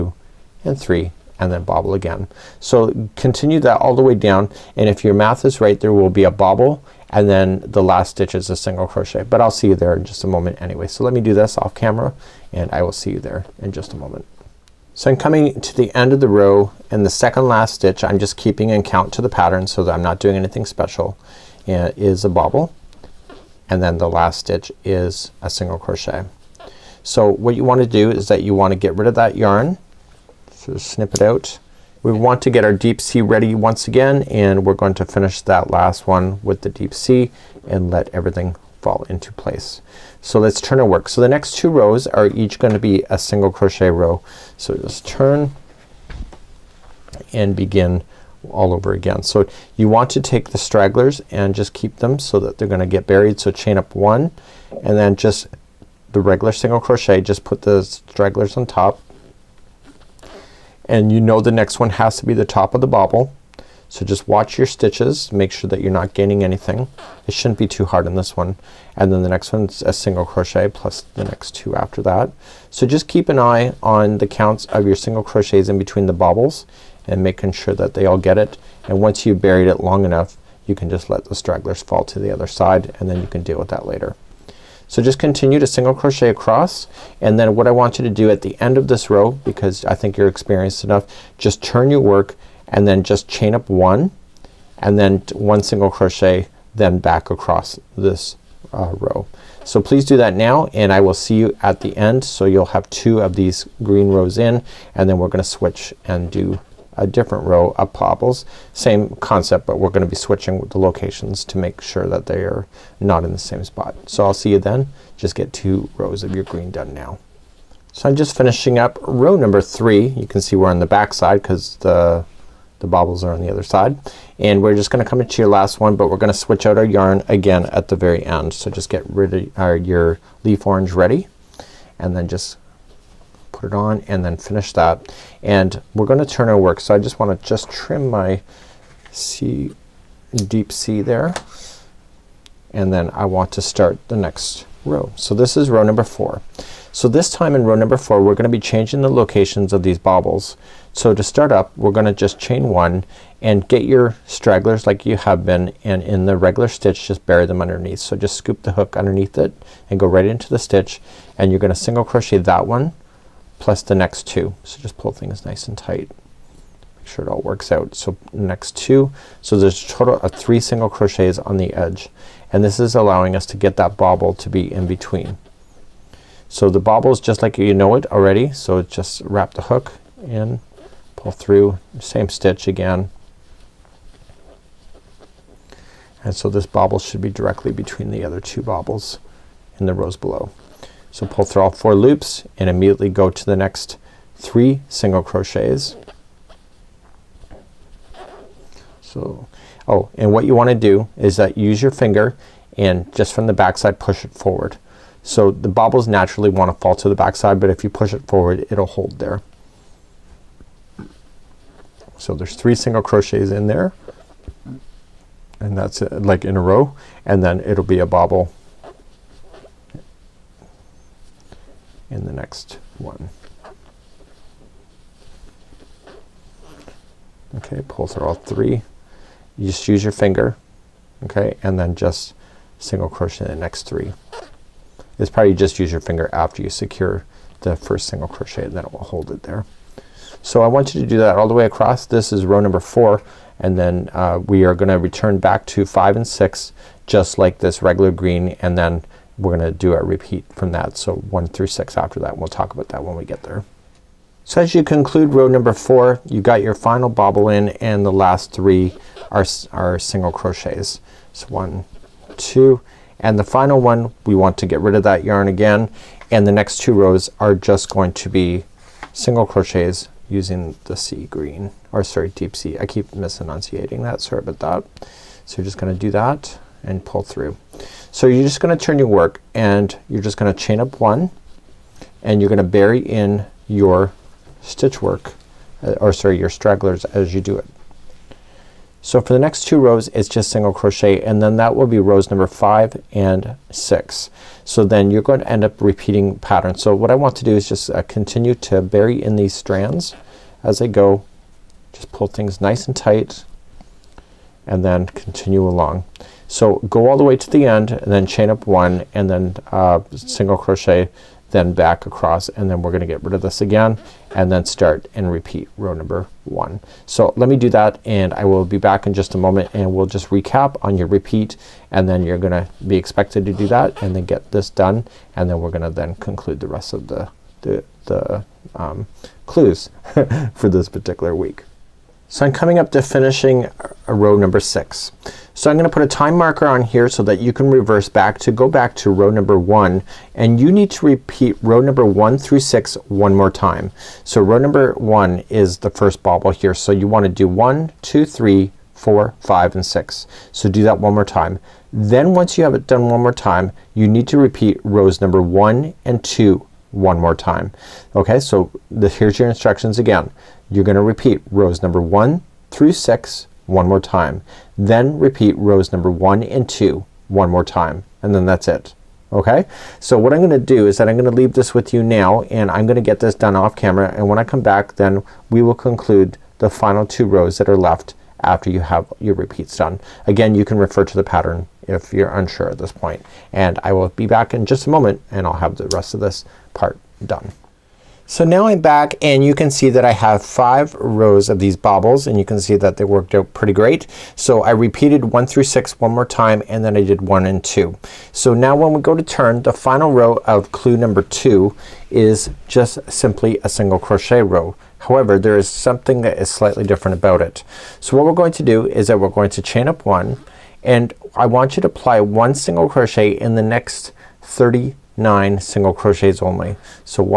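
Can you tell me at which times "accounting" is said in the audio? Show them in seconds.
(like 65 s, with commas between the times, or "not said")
not said.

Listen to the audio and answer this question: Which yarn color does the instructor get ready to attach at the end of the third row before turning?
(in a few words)
Leaf orange.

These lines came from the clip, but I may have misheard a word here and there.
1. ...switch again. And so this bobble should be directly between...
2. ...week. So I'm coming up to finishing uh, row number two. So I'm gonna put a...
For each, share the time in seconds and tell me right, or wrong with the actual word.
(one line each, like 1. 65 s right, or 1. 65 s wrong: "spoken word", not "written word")
1. 182 s wrong: "stitch", not "switch"
2. 331 s wrong: "six", not "two".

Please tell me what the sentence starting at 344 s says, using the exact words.
So row number one is the first bobble here.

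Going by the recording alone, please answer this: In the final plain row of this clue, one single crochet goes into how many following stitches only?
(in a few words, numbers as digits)
39.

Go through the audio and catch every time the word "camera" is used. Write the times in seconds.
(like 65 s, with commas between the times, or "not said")
11 s, 373 s.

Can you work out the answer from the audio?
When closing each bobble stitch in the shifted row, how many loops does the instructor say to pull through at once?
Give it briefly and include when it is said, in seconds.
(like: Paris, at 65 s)
4, at 191 s.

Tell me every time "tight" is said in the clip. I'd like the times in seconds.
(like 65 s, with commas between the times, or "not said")
165 s, 302 s.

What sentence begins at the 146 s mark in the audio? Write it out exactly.
So this time in row number four we're gonna be changing the locations of these bobbles.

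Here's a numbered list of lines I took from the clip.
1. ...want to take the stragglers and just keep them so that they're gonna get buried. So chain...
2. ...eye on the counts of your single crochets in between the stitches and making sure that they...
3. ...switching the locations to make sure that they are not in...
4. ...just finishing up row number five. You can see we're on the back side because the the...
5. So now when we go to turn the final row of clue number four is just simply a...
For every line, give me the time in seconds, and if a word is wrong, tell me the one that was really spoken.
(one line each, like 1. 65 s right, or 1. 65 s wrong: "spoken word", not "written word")
1. 49 s right
2. 73 s wrong: "bobbles", not "stitches"
3. 110 s right
4. 118 s wrong: "three", not "five"
5. 398 s wrong: "two", not "four".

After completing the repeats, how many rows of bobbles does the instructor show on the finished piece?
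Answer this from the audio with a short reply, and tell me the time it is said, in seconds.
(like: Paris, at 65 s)
5, at 390 s.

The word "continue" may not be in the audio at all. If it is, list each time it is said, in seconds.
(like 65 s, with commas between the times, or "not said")
3 s, 85 s, 298 s, 305 s.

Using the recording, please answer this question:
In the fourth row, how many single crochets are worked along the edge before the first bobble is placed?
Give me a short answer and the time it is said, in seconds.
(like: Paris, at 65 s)
3, at 169 s.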